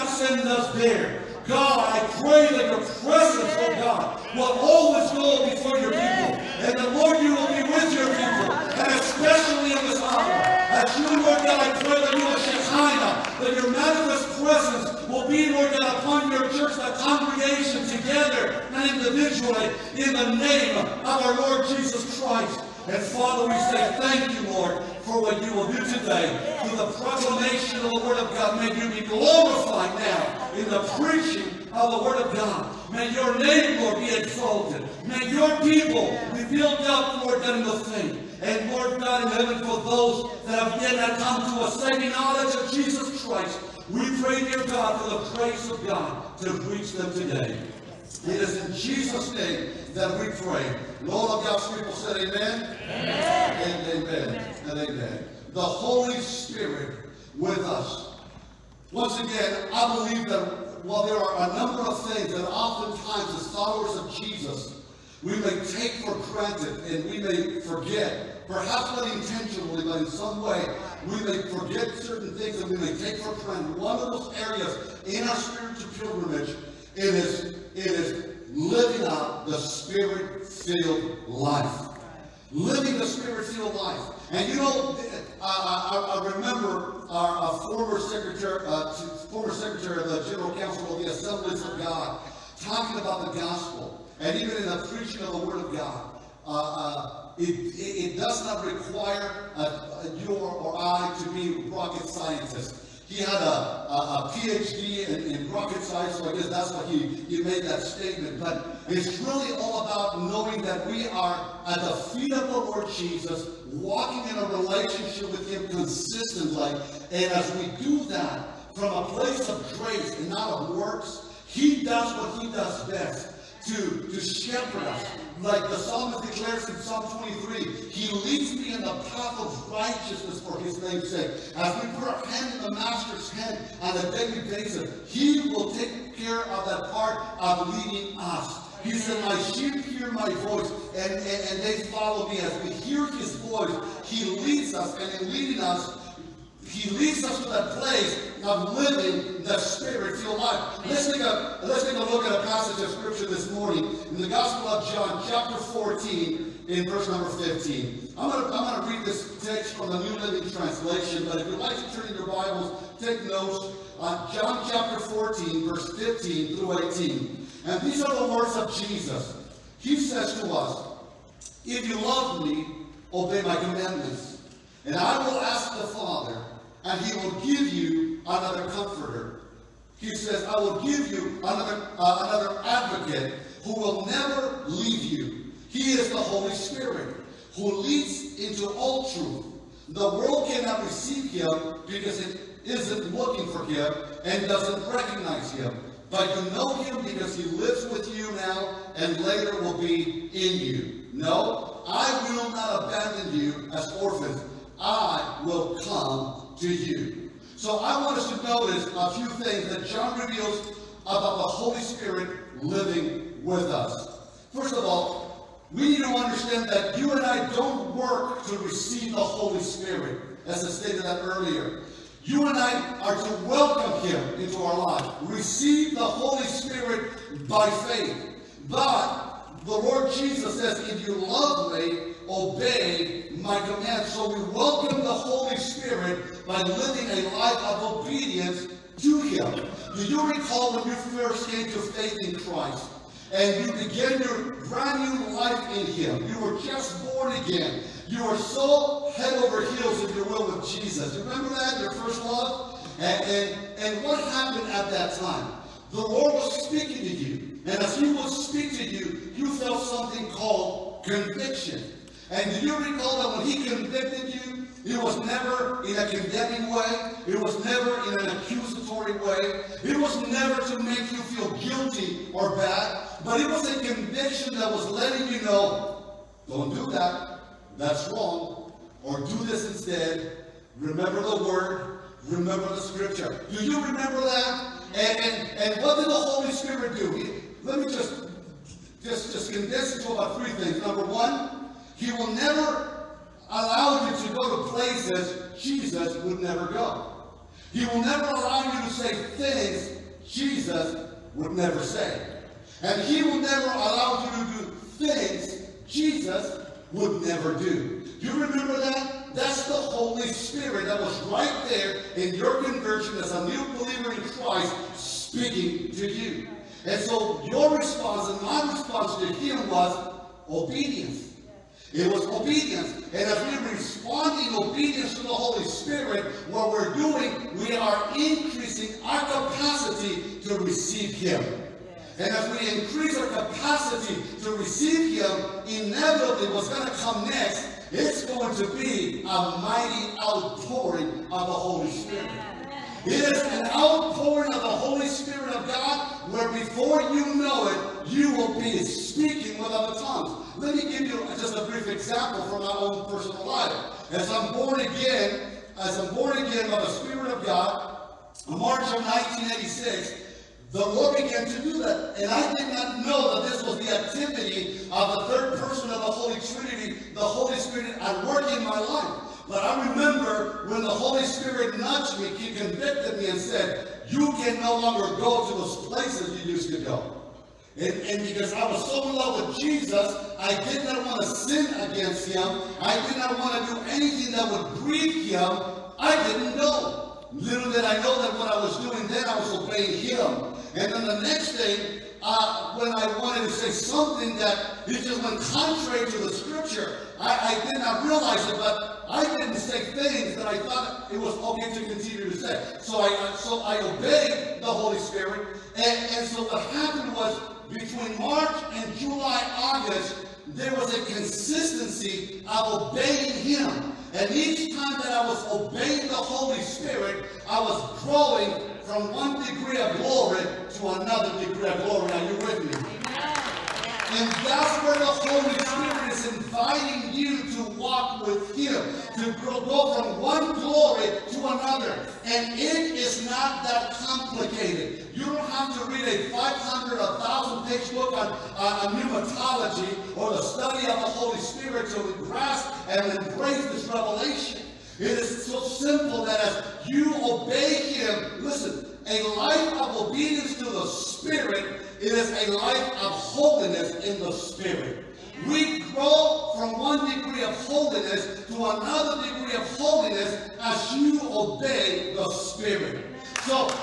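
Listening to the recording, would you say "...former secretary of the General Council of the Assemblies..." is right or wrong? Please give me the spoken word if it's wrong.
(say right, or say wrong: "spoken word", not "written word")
right.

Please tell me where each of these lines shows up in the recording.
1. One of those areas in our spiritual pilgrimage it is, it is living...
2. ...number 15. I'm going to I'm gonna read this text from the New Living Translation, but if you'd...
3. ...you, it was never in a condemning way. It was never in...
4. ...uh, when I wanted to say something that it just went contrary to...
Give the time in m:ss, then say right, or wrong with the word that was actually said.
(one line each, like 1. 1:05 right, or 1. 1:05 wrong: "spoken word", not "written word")
1. 1:13 right
2. 2:37 right
3. 4:24 right
4. 6:32 right.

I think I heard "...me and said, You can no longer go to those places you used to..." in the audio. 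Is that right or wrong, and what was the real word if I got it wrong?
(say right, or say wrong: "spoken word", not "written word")
right.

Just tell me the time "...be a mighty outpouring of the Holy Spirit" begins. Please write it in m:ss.
5:38.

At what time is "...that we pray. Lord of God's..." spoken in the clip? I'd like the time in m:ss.
0:49.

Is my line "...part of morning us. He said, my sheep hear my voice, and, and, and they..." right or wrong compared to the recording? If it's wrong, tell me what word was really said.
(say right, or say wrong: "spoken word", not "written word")
wrong: "leading", not "morning".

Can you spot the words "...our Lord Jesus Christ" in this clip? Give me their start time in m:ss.
0:21.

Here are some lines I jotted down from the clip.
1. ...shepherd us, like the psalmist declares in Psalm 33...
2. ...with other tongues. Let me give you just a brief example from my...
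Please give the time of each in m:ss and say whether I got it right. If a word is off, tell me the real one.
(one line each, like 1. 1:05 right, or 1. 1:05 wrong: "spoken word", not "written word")
1. 2:04 wrong: "23", not "33"
2. 5:49 right.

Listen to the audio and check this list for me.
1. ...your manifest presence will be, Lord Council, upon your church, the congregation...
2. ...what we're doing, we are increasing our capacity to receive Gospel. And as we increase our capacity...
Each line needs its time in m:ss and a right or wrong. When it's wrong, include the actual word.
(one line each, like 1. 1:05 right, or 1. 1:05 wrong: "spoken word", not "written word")
1. 0:13 wrong: "God", not "Council"
2. 5:26 wrong: "Him", not "Gospel".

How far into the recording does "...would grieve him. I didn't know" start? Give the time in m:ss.
6:24.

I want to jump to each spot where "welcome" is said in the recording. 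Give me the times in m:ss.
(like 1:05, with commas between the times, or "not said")
3:43, 3:54.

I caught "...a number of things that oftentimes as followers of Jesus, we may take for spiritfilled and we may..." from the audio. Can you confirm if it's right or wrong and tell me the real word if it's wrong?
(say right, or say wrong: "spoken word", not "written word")
wrong: "granted", not "spiritfilled".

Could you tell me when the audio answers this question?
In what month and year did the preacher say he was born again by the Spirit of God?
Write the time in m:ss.
5:58.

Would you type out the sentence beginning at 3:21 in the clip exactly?
No, I will not abandon you as orphans.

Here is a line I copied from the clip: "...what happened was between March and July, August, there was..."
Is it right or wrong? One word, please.
right.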